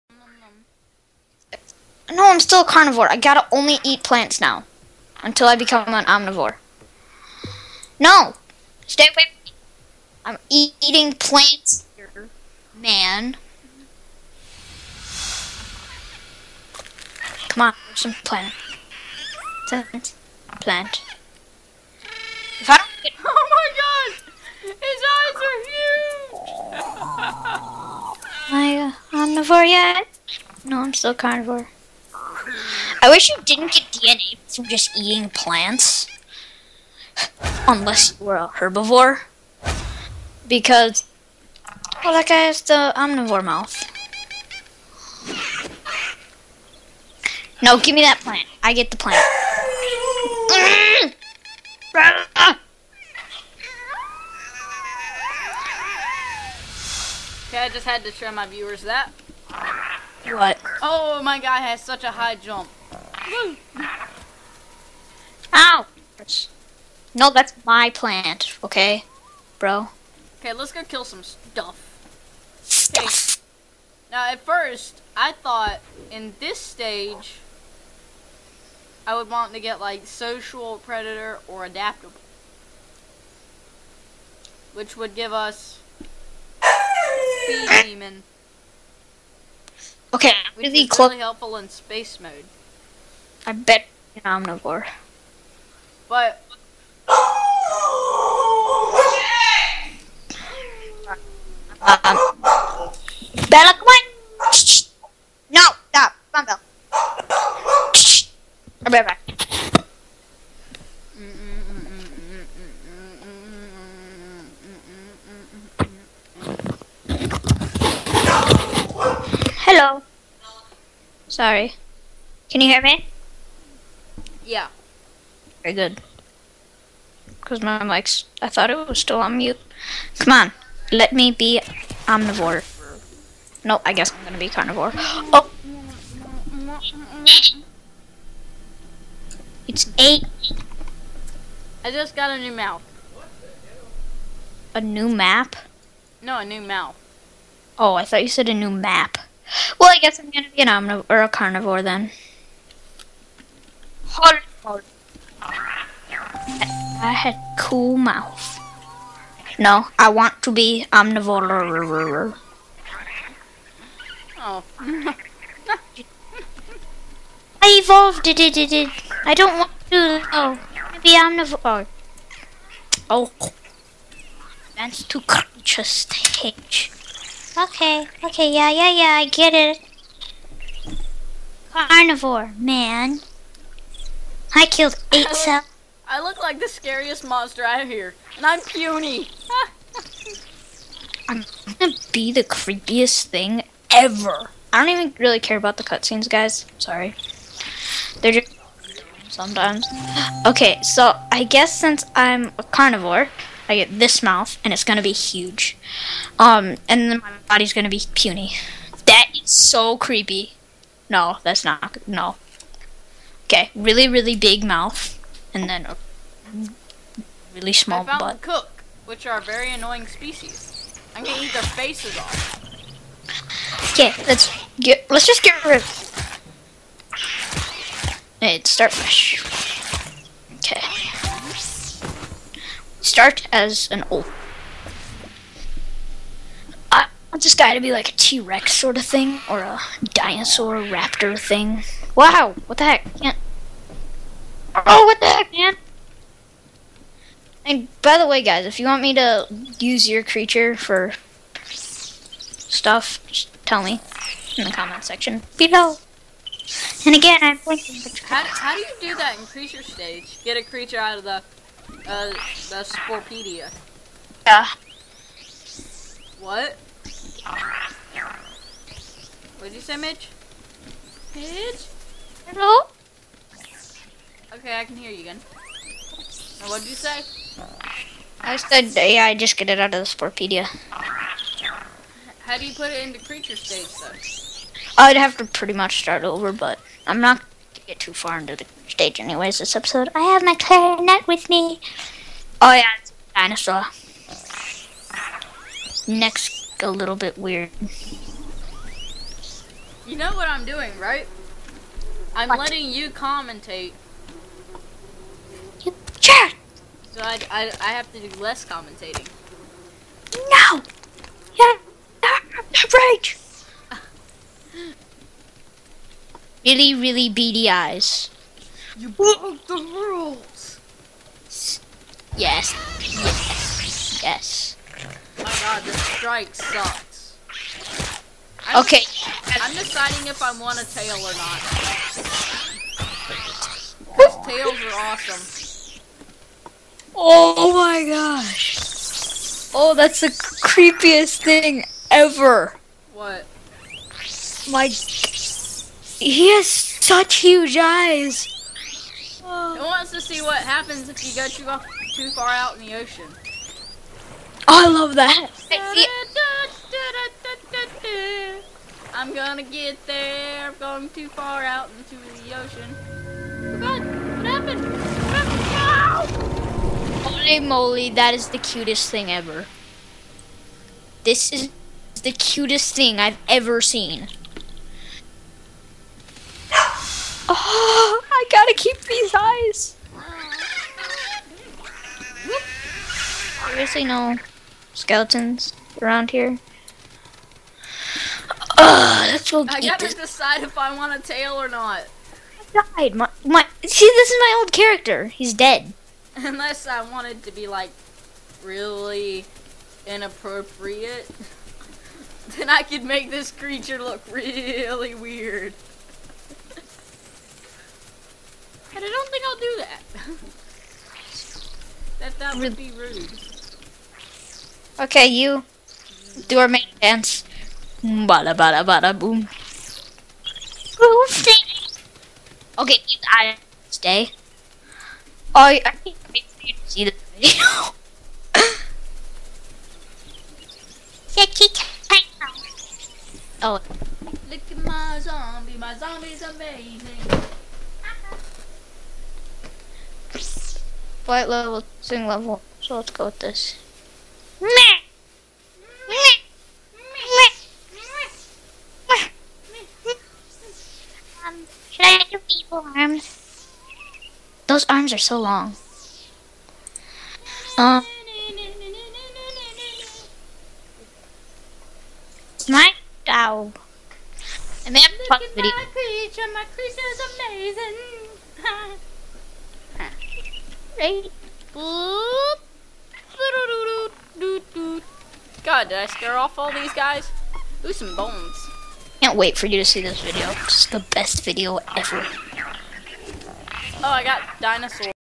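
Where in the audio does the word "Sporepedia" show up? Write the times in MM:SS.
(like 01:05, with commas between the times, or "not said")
04:22, 04:40.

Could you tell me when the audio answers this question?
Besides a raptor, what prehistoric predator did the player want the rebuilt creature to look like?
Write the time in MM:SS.
03:58.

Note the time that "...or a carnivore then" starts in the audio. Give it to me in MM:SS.
02:31.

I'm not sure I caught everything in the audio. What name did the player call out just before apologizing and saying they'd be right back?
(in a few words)
Bella.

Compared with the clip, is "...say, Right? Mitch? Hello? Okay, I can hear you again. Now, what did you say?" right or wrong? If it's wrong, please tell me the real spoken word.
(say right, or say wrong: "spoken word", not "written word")
wrong: "Mitch", not "Right".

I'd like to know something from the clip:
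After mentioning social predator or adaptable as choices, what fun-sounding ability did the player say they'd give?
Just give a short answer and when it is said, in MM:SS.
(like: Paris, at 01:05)
Bee demon, at 01:27.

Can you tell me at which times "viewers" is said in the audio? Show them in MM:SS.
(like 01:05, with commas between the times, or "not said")
00:58.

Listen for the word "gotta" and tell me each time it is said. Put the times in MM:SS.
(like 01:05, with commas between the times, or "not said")
00:03, 06:18, 06:29.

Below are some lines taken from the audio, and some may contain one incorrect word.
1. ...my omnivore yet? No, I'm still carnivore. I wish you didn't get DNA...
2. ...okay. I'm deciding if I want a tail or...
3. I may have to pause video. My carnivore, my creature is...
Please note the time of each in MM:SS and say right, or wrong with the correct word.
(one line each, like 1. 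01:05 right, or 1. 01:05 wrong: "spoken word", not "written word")
1. 00:28 right
2. 05:28 right
3. 07:44 wrong: "creature", not "carnivore".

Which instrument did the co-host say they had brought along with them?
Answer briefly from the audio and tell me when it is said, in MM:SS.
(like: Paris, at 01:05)
Clarinet, at 04:50.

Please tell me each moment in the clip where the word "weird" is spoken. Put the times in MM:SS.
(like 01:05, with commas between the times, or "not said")
04:57, 06:45.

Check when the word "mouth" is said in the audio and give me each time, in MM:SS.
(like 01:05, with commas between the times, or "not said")
00:43, 02:22, 02:26, 02:37, 03:24, 03:34.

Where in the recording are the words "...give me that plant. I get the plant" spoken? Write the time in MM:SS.
00:47.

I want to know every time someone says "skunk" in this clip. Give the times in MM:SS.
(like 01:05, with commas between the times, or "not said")
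not said.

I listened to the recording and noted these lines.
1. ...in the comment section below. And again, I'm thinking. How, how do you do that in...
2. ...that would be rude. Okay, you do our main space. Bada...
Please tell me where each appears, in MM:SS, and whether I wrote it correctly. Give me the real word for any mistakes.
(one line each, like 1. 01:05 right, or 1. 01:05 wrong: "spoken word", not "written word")
1. 04:14 right
2. 06:52 wrong: "dance", not "space".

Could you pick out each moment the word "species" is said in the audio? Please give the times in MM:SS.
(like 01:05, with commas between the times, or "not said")
03:40.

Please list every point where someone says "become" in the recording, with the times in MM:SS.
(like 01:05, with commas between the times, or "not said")
00:05.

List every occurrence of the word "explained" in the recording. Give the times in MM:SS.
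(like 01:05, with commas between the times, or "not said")
not said.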